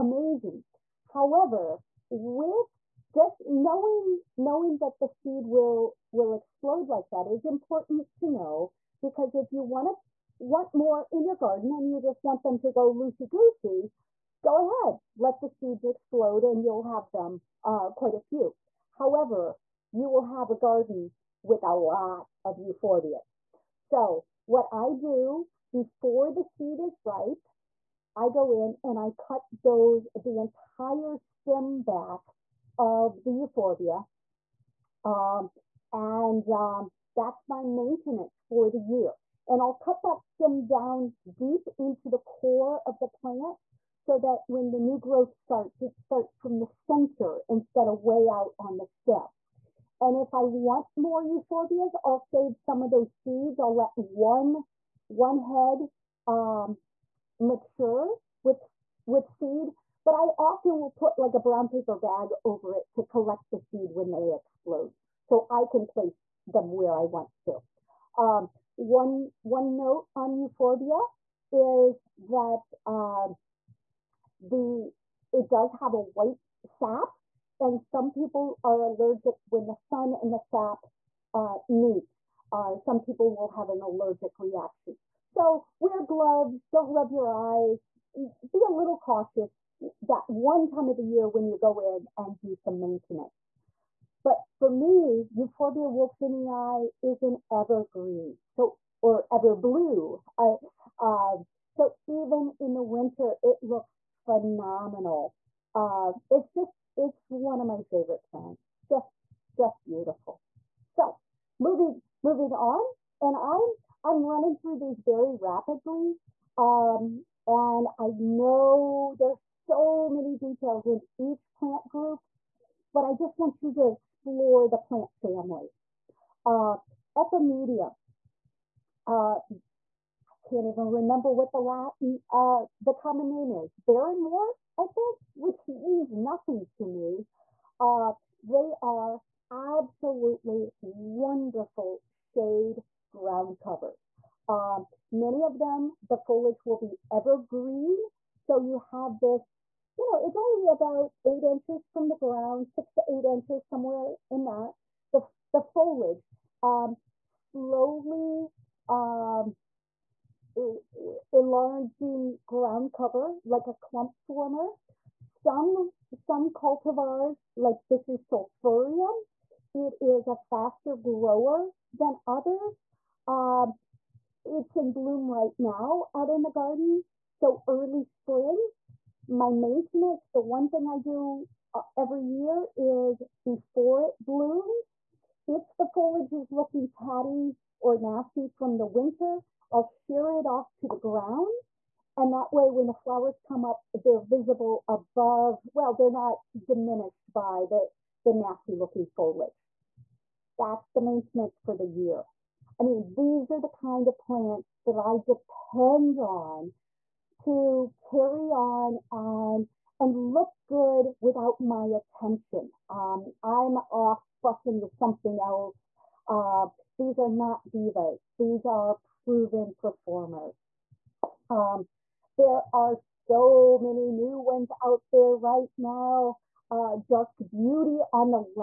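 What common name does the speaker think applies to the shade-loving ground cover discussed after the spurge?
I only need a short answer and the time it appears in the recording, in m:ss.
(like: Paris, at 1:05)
Barrenwort, at 2:13.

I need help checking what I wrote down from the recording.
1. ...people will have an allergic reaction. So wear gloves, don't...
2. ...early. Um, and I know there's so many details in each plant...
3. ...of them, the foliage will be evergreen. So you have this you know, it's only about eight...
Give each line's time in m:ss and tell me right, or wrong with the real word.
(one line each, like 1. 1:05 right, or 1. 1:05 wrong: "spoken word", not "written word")
1. 1:22 right
2. 1:55 wrong: "rapidly", not "early"
3. 2:25 right.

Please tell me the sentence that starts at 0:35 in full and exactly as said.
Um, and um, that's my maintenance for the year.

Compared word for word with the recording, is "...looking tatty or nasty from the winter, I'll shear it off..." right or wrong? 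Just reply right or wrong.
right.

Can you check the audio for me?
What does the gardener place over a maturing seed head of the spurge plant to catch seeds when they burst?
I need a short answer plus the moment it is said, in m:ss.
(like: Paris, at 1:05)
Brown paper bag, at 1:01.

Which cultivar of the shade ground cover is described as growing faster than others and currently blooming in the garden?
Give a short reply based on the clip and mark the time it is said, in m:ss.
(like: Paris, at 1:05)
Sulphureum, at 2:48.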